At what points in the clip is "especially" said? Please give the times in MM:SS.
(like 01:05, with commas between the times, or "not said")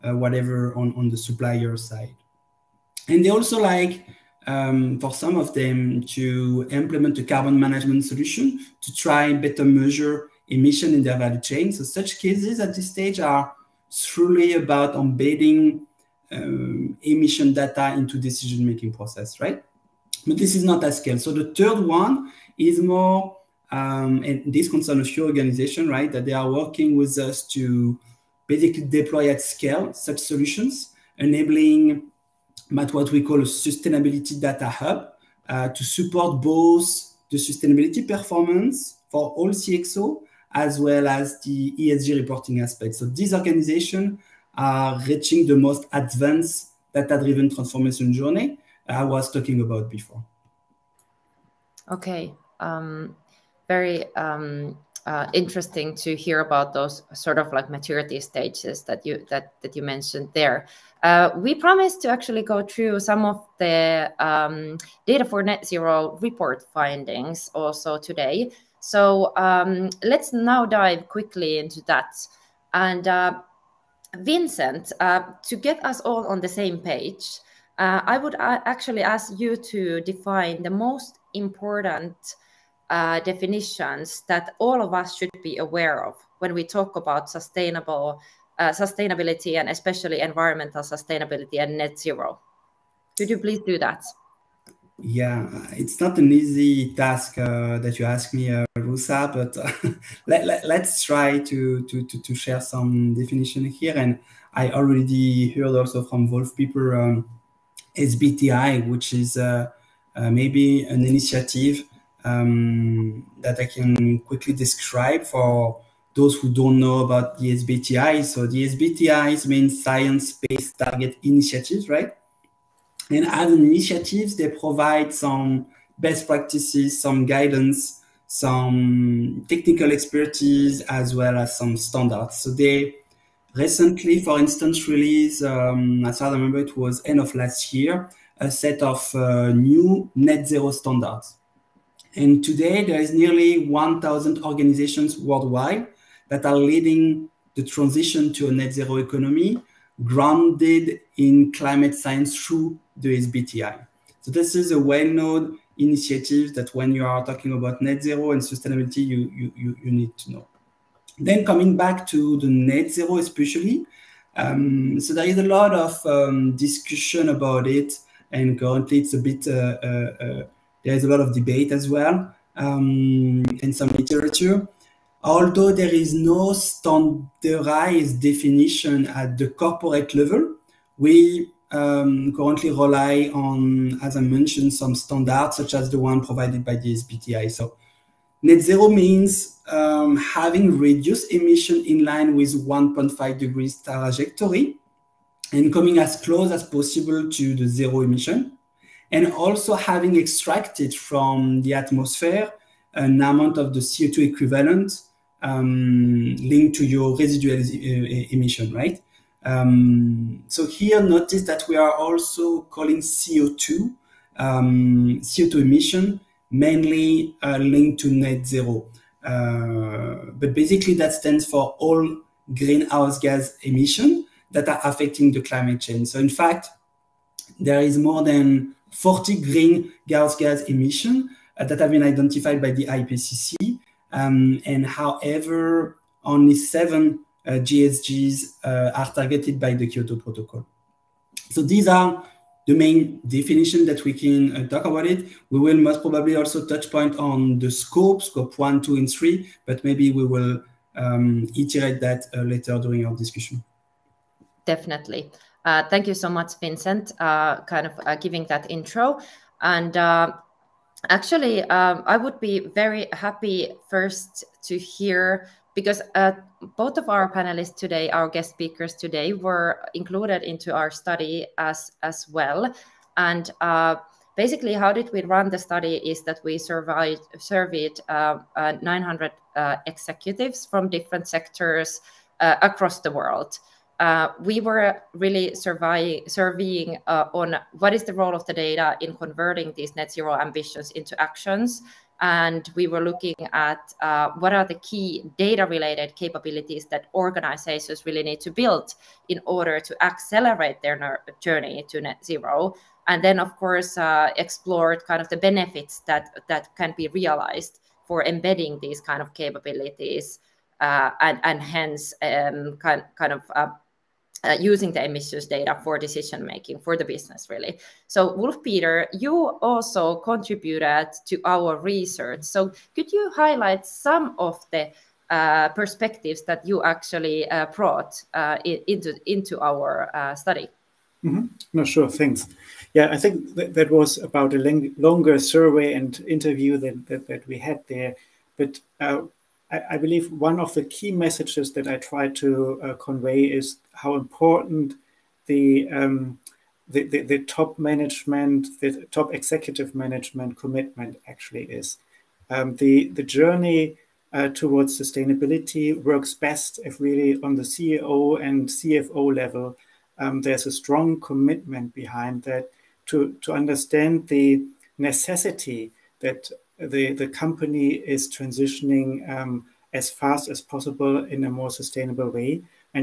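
01:29, 02:43.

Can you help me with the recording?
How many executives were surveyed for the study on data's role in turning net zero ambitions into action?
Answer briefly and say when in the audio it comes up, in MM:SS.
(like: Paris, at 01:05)
900, at 04:38.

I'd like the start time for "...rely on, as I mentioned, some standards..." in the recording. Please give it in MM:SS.
03:02.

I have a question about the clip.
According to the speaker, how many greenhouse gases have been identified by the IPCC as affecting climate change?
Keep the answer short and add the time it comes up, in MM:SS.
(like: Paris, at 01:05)
more than 40, at 03:47.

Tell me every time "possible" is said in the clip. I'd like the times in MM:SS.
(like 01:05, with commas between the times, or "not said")
03:16, 06:10.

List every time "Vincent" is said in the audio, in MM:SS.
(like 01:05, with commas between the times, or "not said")
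01:14, 04:16.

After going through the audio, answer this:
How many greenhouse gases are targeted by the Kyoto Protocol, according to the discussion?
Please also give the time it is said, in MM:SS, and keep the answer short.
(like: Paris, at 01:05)
7, at 03:56.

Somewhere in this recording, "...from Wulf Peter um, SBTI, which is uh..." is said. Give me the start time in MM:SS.
01:46.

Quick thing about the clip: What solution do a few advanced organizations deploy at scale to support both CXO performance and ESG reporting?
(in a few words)
sustainability data hub.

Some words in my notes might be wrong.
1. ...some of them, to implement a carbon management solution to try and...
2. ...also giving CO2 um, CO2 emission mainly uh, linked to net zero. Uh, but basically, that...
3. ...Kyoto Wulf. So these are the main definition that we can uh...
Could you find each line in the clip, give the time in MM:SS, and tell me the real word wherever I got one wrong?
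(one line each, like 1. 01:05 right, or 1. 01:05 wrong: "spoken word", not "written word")
1. 00:05 right
2. 03:31 wrong: "calling", not "giving"
3. 03:59 wrong: "Protocol", not "Wulf".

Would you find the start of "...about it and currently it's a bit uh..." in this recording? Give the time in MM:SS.
02:47.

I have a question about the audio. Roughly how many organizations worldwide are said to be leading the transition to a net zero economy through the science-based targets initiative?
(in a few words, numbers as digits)
1,000.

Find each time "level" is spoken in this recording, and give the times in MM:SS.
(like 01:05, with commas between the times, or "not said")
03:00, 05:59.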